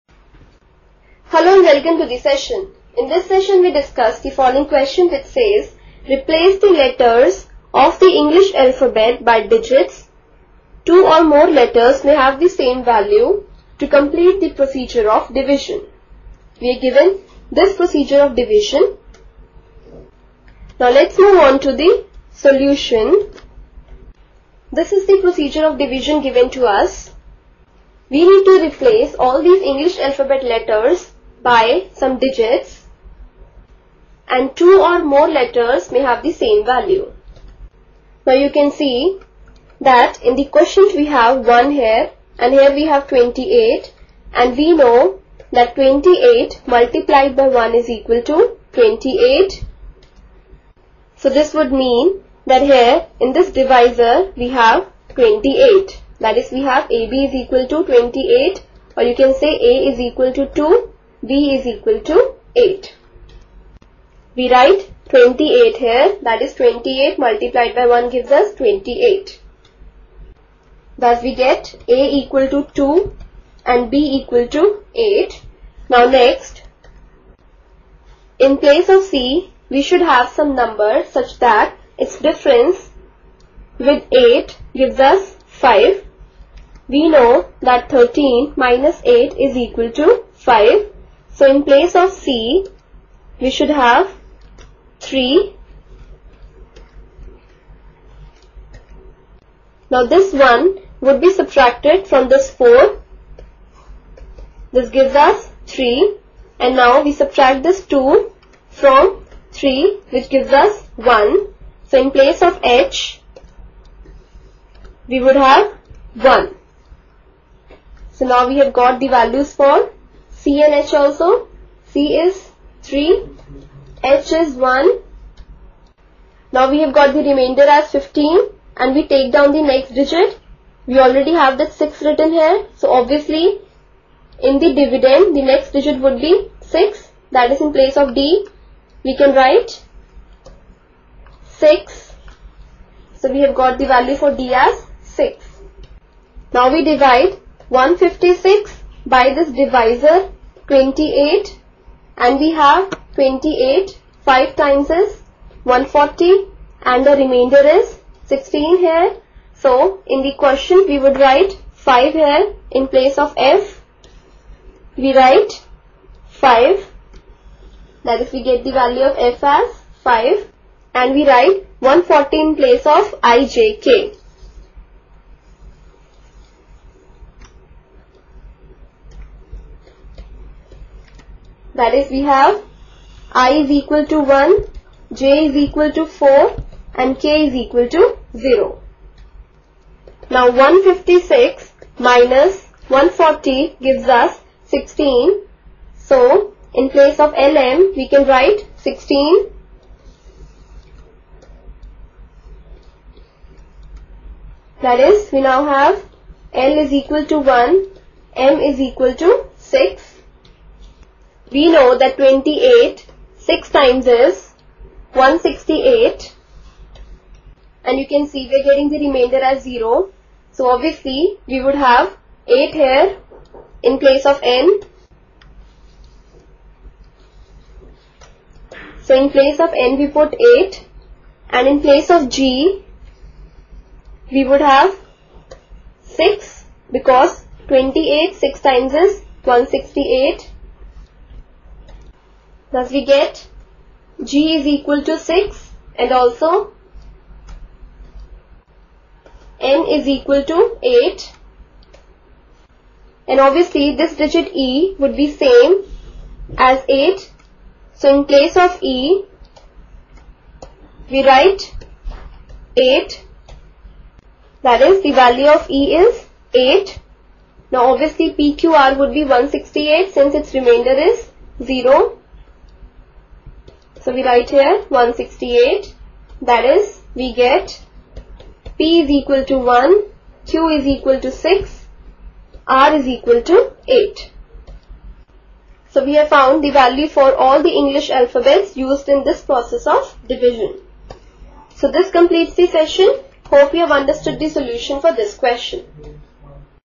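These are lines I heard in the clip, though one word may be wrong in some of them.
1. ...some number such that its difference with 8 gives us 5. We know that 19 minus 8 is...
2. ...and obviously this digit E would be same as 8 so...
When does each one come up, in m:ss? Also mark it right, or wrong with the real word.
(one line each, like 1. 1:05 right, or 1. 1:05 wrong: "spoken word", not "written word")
1. 1:20 wrong: "13", not "19"
2. 4:13 right.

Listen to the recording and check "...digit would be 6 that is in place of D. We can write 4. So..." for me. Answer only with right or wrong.
wrong.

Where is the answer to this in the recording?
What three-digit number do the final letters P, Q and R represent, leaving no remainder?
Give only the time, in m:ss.
4:28.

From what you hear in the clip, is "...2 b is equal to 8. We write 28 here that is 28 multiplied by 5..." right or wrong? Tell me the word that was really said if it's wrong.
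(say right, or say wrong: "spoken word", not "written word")
wrong: "1", not "5".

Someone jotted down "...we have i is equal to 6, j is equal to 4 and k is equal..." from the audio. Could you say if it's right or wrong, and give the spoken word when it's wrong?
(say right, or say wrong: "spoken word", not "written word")
wrong: "1", not "6".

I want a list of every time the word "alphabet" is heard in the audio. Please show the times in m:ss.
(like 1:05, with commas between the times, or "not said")
0:08, 0:30, 4:48.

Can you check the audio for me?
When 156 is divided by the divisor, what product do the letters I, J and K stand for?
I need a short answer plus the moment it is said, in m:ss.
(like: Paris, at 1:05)
140, at 2:51.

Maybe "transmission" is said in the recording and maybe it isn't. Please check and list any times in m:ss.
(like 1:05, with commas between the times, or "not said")
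not said.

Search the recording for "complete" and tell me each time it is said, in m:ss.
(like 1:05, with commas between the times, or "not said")
0:13, 4:52.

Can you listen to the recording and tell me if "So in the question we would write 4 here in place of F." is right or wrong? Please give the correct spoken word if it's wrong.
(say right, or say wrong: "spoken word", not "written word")
wrong: "5", not "4".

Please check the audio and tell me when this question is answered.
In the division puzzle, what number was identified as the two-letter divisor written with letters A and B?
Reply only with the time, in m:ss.
0:56.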